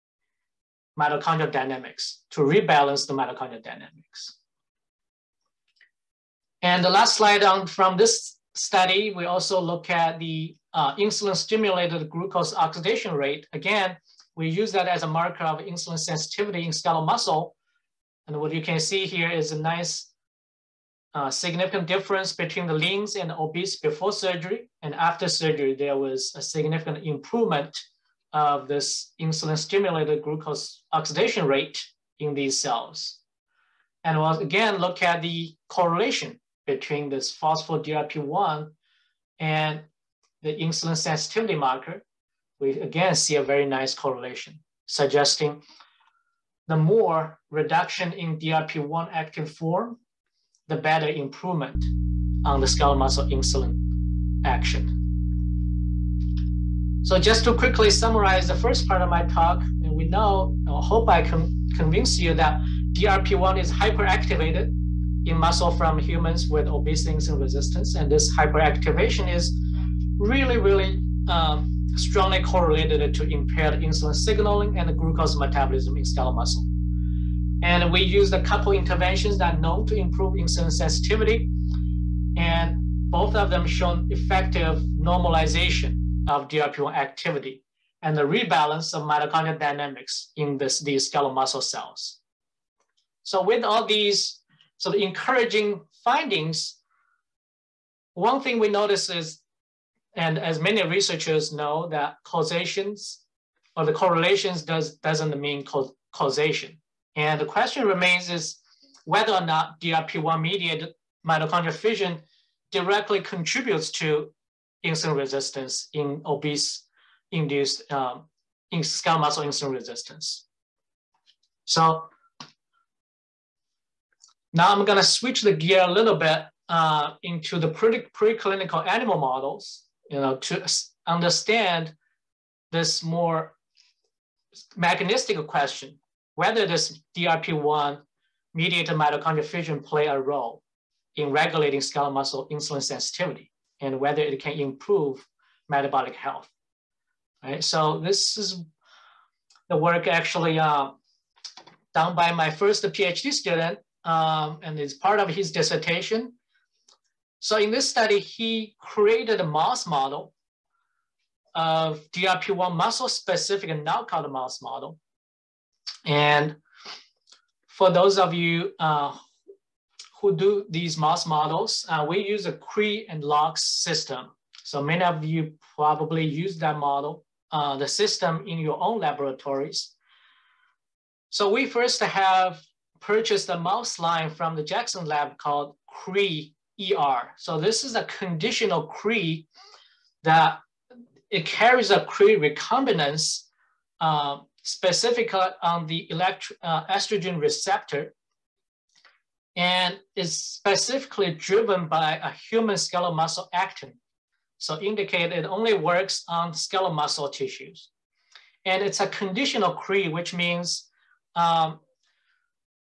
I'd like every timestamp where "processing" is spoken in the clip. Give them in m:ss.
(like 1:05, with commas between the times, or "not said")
not said.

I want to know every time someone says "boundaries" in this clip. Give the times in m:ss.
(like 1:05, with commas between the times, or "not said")
not said.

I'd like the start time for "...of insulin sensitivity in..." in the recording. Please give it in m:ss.
0:15.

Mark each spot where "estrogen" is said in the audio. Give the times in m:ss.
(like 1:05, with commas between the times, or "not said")
3:16.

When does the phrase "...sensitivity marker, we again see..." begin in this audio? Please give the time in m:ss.
0:40.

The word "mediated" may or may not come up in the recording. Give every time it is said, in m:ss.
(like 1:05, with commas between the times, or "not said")
1:49, 2:18.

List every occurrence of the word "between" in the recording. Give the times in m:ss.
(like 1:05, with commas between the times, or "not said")
0:22, 0:36.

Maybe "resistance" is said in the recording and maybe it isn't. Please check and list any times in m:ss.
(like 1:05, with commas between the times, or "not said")
1:07, 1:55, 1:59.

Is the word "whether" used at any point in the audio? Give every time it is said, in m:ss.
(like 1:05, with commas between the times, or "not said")
1:49, 2:16, 2:23.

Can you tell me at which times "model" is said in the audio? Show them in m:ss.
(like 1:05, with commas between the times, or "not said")
2:09, 2:39, 2:44, 2:51, 2:56.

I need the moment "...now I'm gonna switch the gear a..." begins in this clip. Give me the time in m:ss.
2:04.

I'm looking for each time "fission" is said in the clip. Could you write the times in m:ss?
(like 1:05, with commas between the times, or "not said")
1:51, 2:19.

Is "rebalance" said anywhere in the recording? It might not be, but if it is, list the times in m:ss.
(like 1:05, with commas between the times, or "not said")
0:02, 1:28.